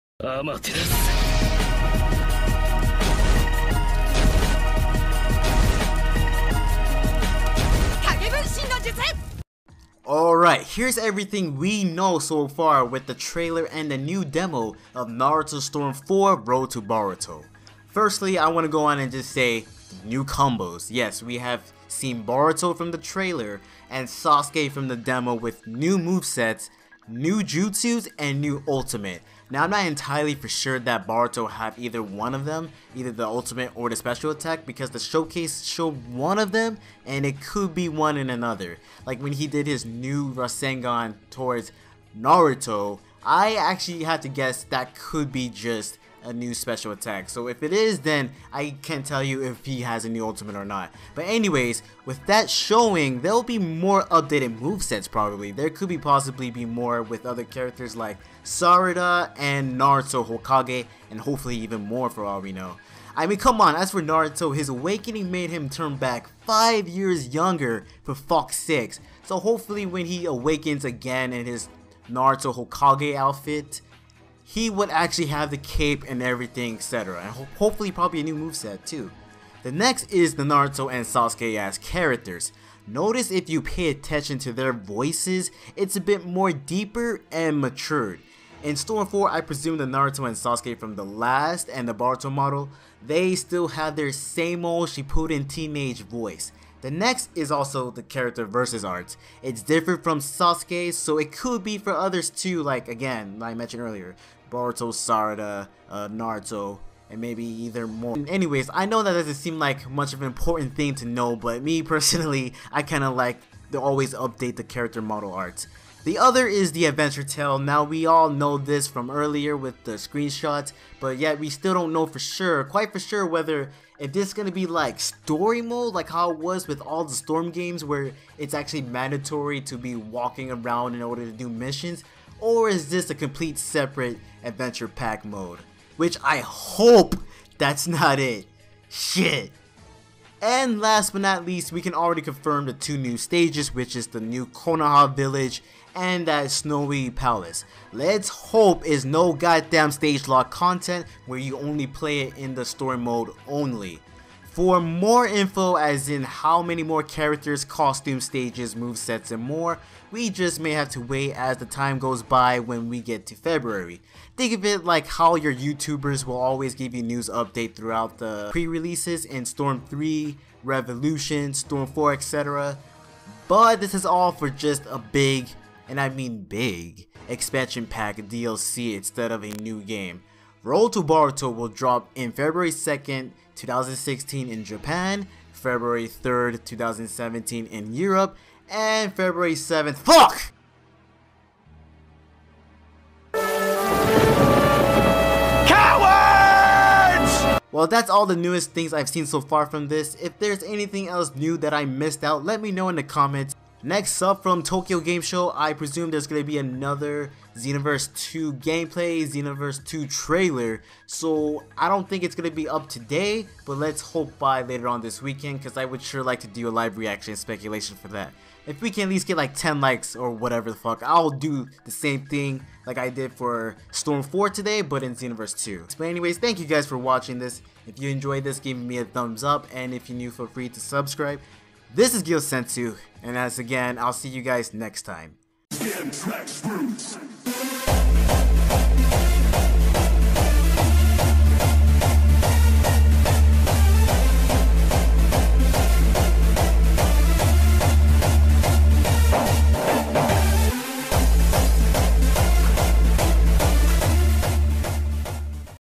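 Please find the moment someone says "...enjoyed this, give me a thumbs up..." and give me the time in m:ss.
3:48.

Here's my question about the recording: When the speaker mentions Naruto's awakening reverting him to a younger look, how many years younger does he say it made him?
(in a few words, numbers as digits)
5.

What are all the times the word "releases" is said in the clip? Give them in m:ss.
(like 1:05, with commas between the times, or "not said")
2:48.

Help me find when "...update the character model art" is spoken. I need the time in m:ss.
1:54.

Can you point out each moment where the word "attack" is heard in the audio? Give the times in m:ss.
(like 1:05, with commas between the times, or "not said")
0:34, 0:46.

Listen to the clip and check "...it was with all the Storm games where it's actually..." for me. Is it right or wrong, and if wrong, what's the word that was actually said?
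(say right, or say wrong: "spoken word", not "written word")
right.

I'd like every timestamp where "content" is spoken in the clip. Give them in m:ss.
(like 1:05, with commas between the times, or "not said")
2:30.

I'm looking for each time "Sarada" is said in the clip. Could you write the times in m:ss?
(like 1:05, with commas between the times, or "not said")
0:58, 1:44.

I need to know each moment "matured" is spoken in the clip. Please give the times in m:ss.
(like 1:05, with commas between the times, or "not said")
1:27.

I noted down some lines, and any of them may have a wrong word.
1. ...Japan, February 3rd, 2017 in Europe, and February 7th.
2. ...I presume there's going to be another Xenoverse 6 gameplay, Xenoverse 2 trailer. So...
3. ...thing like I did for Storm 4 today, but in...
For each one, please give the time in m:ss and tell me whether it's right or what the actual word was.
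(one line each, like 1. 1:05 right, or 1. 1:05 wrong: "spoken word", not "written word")
1. 3:04 right
2. 3:25 wrong: "2", not "6"
3. 3:42 right.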